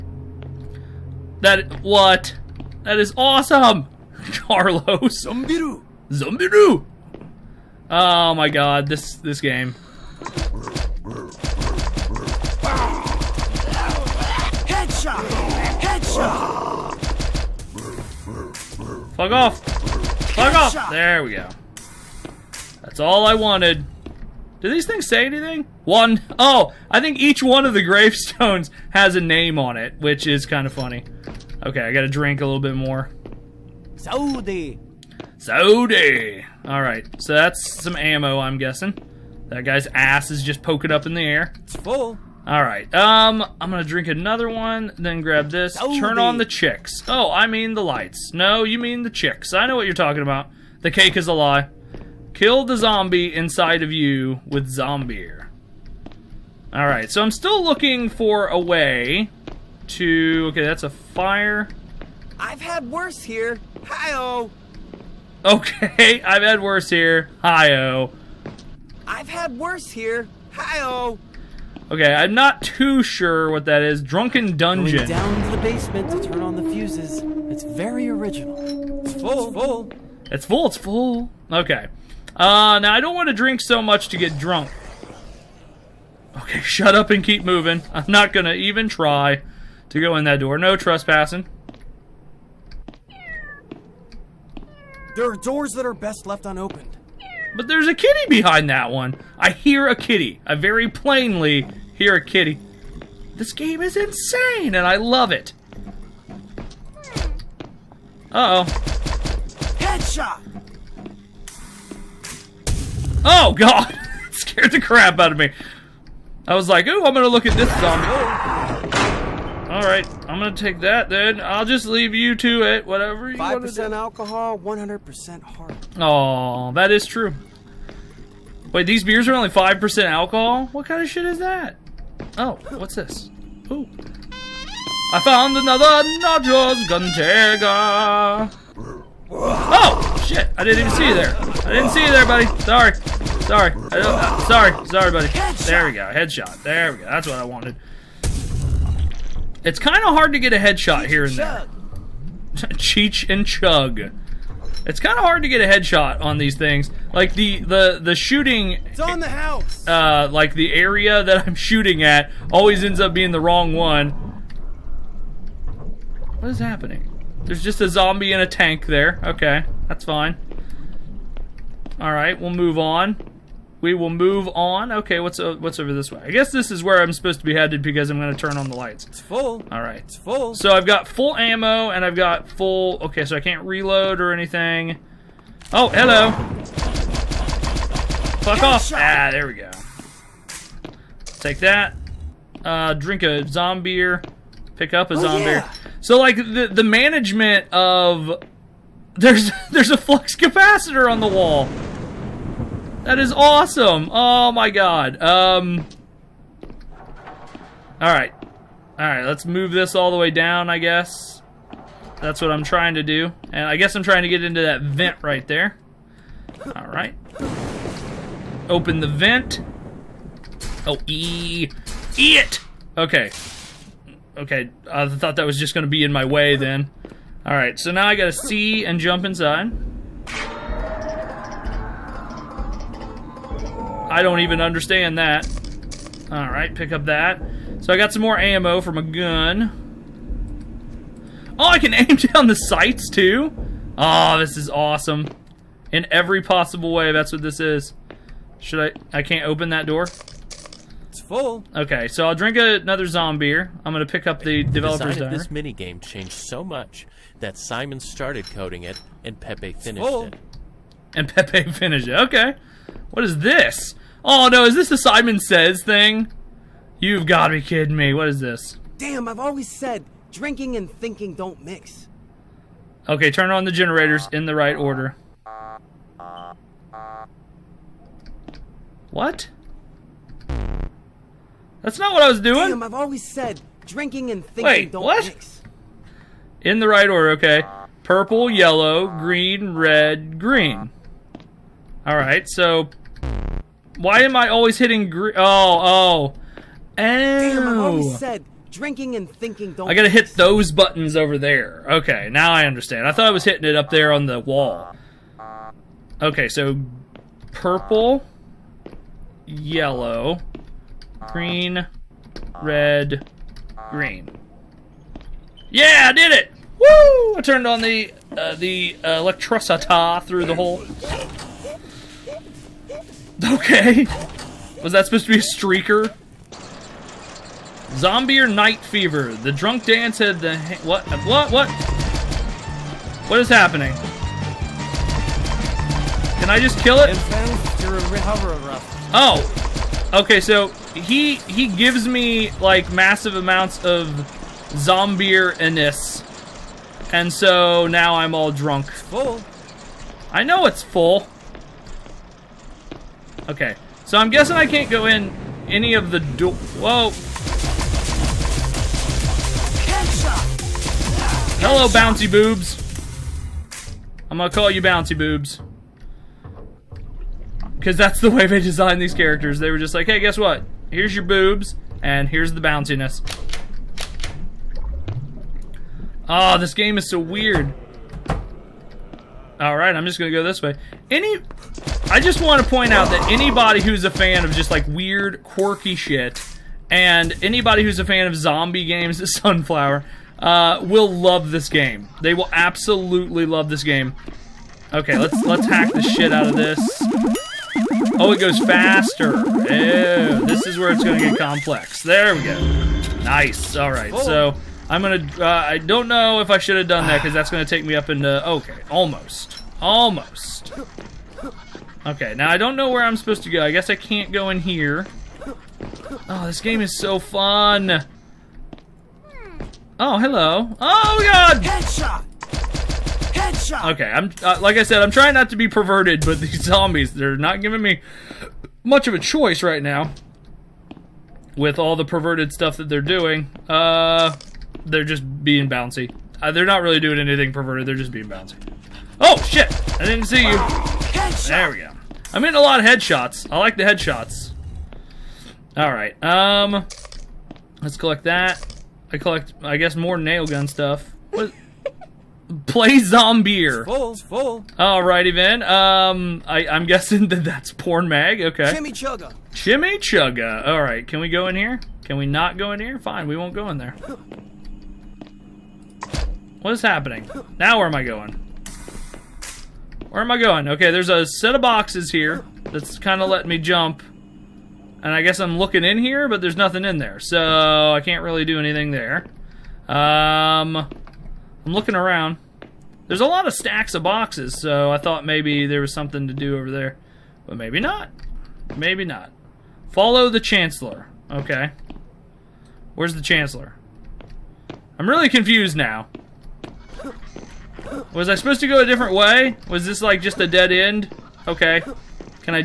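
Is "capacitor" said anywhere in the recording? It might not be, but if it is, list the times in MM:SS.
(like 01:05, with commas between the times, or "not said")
03:20.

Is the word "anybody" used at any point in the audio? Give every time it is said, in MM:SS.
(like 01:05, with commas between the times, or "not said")
06:23, 06:27.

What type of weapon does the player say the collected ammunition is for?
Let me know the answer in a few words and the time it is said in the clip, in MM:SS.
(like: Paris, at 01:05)
nail gun, at 07:30.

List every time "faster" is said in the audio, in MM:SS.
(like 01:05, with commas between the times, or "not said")
06:38.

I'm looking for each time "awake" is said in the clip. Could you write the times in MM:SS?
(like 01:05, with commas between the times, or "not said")
not said.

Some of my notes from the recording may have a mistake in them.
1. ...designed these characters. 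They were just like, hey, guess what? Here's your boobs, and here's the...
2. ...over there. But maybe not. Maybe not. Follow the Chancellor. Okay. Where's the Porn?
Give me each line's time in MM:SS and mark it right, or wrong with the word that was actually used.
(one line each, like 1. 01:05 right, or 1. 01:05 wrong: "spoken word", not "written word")
1. 06:08 right
2. 08:06 wrong: "Chancellor", not "Porn".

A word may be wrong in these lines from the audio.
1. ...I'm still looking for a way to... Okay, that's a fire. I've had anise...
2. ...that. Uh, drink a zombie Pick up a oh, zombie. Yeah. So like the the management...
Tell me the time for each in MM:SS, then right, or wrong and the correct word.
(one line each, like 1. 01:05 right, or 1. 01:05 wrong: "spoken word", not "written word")
1. 00:57 wrong: "worse", not "anise"
2. 03:11 right.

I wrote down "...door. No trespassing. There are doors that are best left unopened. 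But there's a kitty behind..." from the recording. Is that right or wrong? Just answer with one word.
right.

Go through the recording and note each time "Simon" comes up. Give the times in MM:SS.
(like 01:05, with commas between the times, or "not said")
04:17, 04:24.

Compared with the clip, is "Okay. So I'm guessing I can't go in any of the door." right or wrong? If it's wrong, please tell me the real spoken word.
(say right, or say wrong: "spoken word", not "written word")
right.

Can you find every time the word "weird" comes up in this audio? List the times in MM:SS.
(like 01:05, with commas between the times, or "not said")
06:17, 06:24.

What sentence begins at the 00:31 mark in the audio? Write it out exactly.
Okay, I gotta drink a little bit more.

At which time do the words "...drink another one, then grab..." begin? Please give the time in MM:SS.
00:43.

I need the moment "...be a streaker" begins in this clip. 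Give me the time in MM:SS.
05:25.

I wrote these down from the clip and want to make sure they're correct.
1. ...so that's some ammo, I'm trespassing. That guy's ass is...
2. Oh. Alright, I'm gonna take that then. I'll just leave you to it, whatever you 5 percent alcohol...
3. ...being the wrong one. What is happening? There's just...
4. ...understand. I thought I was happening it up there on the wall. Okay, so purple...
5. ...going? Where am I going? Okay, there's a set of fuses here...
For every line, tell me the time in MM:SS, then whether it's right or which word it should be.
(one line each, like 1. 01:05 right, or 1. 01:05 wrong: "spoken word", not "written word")
1. 00:37 wrong: "guessing", not "trespassing"
2. 01:58 right
3. 02:43 right
4. 05:02 wrong: "hitting", not "happening"
5. 07:48 wrong: "boxes", not "fuses".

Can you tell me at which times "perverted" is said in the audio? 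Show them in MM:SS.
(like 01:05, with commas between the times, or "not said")
07:05, 07:12, 07:17.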